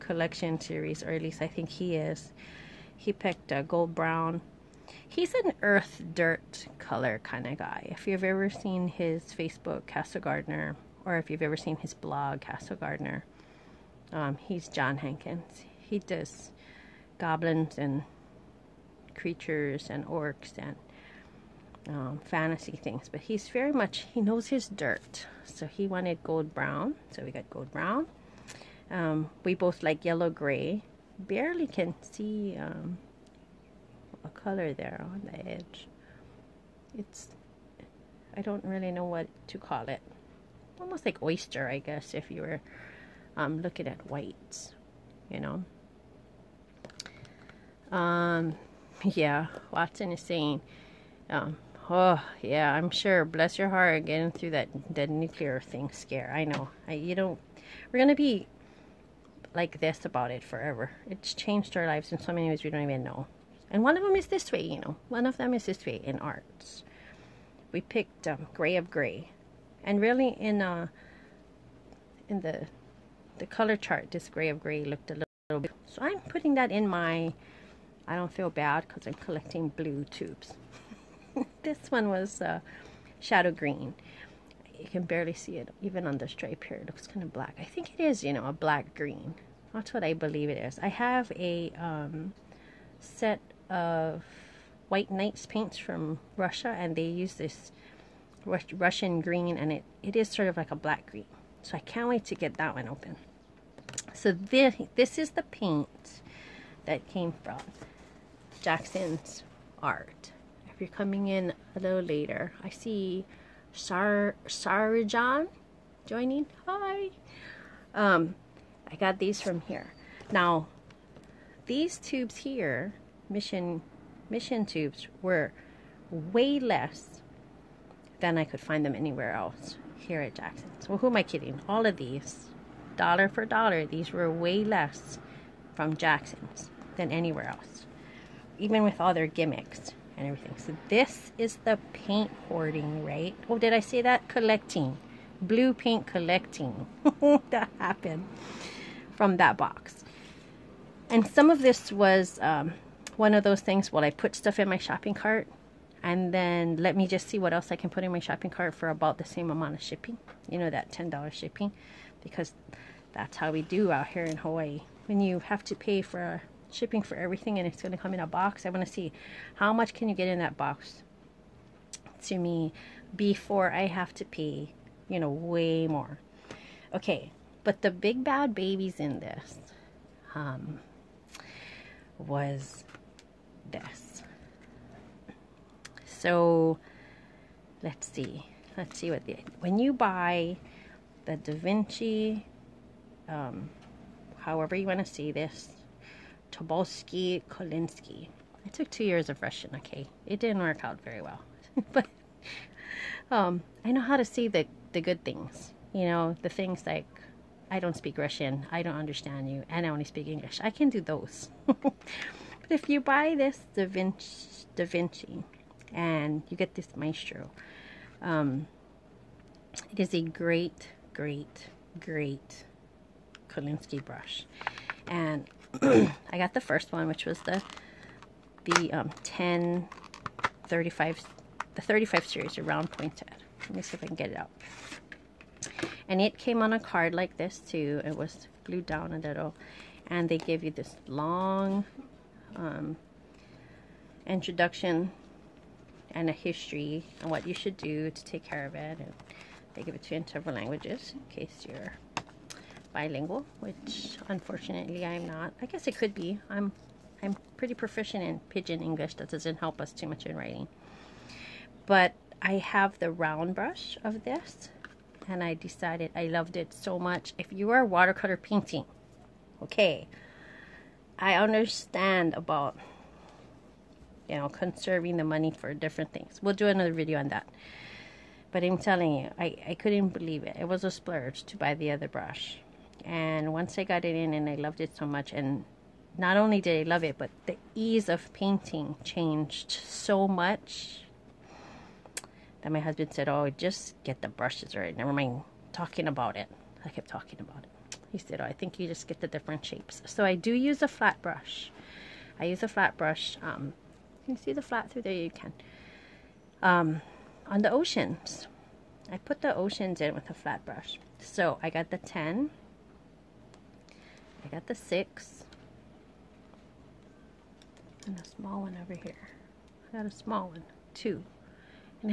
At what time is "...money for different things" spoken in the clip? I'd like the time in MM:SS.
04:35.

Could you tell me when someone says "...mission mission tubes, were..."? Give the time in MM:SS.
02:03.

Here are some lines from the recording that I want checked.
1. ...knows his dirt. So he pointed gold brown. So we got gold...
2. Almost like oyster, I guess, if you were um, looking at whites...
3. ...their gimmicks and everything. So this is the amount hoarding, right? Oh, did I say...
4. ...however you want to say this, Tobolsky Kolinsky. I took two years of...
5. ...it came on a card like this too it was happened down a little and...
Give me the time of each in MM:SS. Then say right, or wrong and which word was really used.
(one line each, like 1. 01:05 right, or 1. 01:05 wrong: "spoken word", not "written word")
1. 00:24 wrong: "wanted", not "pointed"
2. 00:40 right
3. 02:19 wrong: "paint", not "amount"
4. 03:14 right
5. 03:56 wrong: "glued", not "happened".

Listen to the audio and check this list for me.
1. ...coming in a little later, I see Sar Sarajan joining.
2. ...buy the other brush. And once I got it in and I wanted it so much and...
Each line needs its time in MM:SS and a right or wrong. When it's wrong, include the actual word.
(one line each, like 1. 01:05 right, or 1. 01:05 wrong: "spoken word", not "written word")
1. 01:50 right
2. 04:41 wrong: "loved", not "wanted".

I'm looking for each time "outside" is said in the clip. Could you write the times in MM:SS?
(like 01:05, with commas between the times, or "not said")
not said.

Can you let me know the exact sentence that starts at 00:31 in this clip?
Barely can see um, a color there on the edge.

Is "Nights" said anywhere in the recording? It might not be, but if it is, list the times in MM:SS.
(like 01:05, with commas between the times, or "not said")
01:35.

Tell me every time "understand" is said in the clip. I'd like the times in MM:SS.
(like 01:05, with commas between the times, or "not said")
03:28, 04:31.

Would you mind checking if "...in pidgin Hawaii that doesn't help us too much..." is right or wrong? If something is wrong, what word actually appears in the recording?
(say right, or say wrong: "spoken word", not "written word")
wrong: "English", not "Hawaii".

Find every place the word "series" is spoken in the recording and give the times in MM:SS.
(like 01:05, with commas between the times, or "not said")
00:00, 03:52.